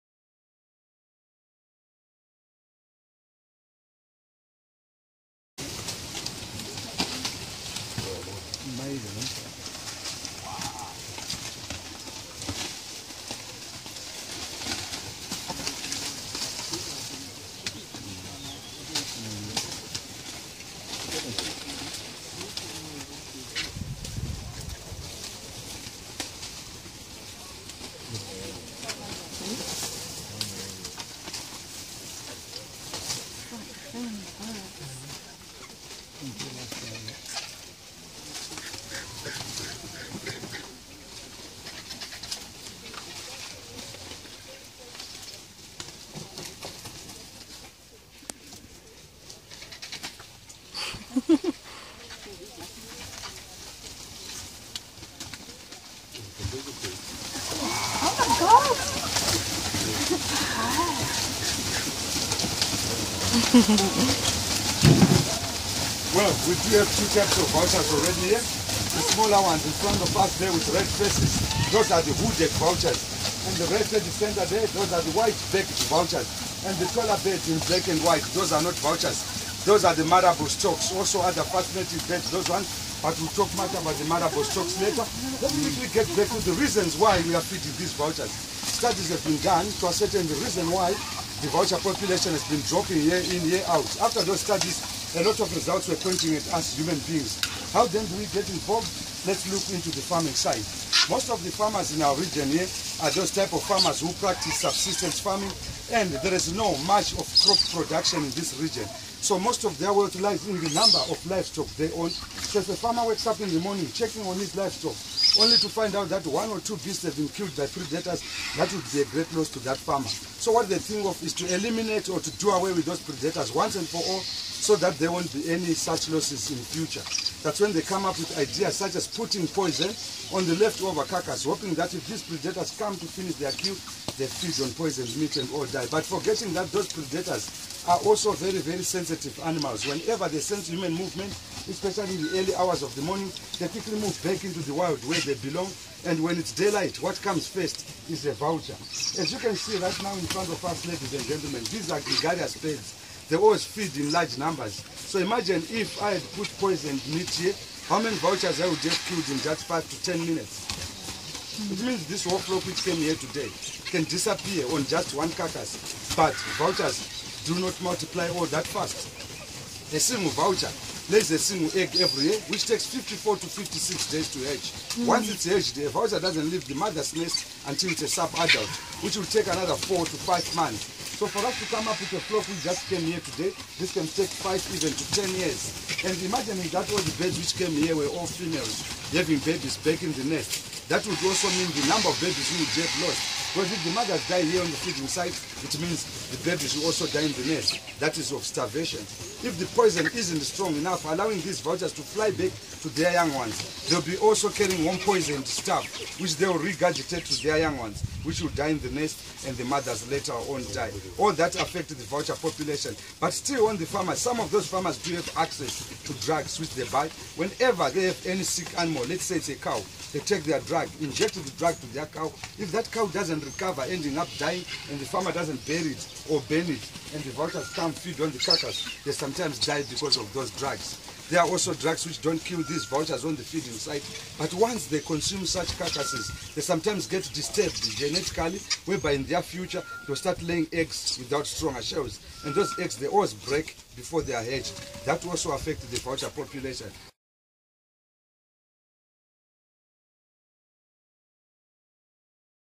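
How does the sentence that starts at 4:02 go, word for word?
And those eggs, they always break before they are hatched.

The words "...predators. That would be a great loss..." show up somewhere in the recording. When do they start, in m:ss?
1:57.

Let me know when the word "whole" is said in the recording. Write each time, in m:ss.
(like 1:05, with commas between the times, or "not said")
2:42.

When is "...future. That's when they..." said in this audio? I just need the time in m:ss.
2:06.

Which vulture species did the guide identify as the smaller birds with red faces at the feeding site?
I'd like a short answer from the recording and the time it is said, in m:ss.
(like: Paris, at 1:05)
hooded vultures, at 1:12.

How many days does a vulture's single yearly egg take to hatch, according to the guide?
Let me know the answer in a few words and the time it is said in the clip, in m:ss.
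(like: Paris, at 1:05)
54 to 56 days, at 2:52.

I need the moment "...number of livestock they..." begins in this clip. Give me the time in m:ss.
1:50.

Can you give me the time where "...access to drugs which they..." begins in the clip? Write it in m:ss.
3:35.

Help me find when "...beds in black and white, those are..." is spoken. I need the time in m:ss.
1:17.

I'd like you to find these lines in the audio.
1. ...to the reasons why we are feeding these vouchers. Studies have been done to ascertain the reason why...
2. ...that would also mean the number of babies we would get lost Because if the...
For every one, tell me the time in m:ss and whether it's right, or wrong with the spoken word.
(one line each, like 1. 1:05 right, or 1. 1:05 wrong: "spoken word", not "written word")
1. 1:26 right
2. 3:10 right.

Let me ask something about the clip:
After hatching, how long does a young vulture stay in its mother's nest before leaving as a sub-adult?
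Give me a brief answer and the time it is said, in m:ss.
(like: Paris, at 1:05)
4 to 5 months, at 2:59.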